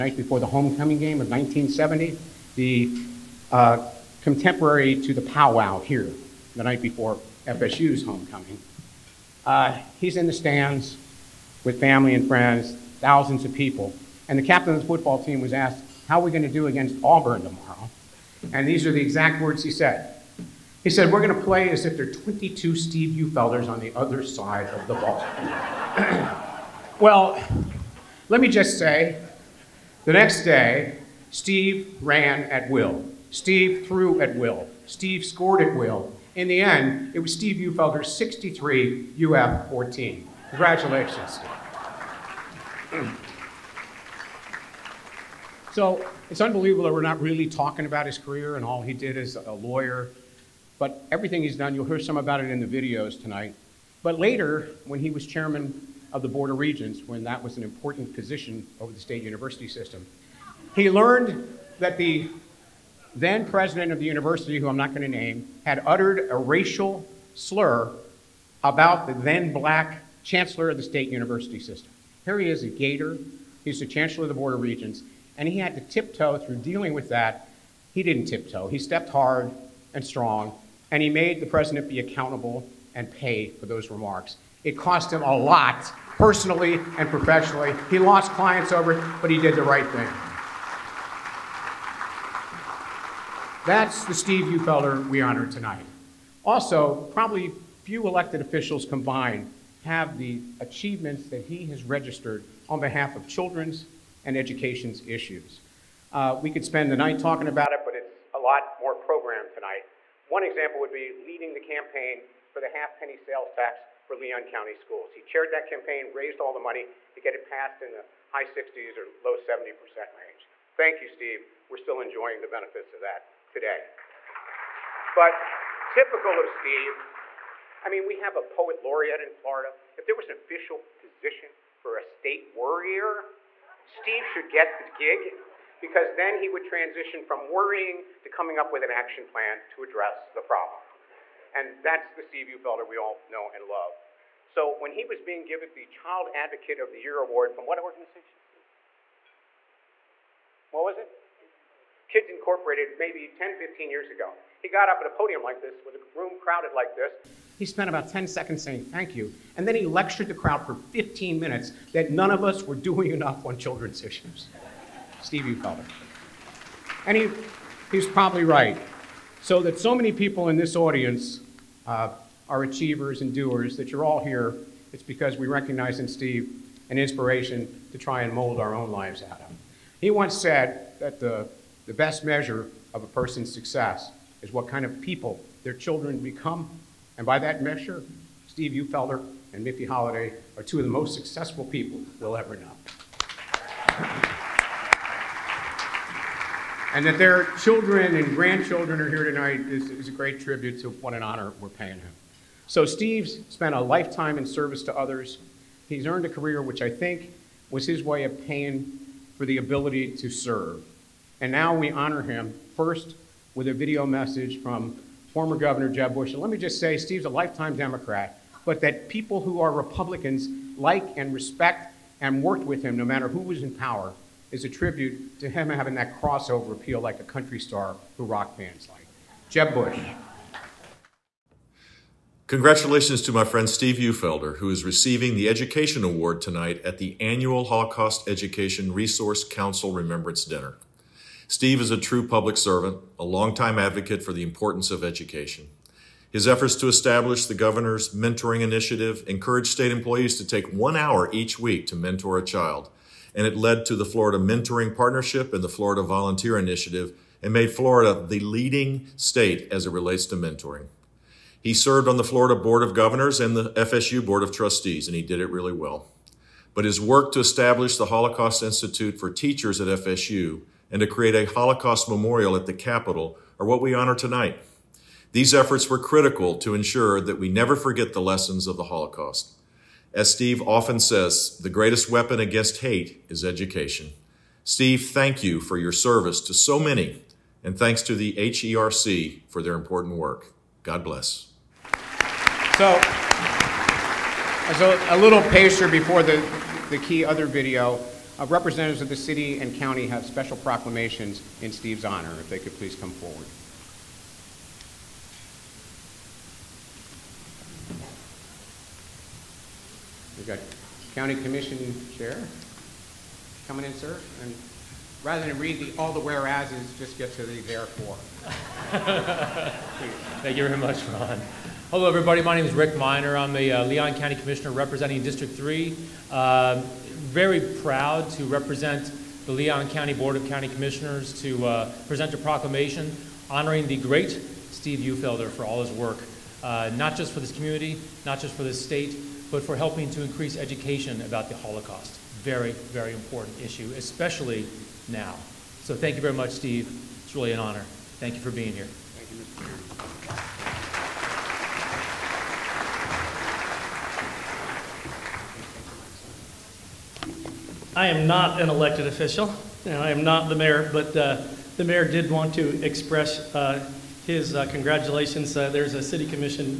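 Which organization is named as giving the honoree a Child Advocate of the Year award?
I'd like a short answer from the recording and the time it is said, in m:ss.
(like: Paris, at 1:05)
Kids Incorporated, at 2:32.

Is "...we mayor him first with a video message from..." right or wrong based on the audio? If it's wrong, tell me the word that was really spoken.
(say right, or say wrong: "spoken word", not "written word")
wrong: "honor", not "mayor".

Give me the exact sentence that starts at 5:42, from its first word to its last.
Very, very important issue, especially now.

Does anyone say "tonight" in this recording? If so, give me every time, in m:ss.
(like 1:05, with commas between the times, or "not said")
0:53, 1:35, 1:49, 3:19, 3:56, 4:34.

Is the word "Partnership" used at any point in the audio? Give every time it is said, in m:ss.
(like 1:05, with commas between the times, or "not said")
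4:14.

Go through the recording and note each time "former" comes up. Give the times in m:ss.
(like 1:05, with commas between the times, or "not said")
3:35.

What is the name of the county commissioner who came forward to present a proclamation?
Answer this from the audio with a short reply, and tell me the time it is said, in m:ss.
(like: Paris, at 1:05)
Rick Minor, at 5:22.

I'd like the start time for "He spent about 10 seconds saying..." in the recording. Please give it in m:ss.
2:37.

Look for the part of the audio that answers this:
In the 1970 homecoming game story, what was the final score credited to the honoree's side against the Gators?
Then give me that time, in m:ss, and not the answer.
0:38.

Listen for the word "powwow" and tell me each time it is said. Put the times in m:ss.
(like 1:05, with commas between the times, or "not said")
0:05.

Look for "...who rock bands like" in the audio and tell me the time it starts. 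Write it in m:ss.
3:48.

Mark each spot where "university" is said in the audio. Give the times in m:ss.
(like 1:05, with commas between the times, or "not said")
0:59, 1:04, 1:11.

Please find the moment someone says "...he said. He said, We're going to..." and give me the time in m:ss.
0:19.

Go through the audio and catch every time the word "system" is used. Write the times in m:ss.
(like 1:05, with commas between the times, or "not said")
0:59, 1:11.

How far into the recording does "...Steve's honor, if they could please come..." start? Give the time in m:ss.
5:01.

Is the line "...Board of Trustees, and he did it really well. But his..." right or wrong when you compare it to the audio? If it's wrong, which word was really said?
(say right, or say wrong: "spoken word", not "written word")
right.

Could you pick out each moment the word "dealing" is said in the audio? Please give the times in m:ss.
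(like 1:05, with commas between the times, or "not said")
1:16.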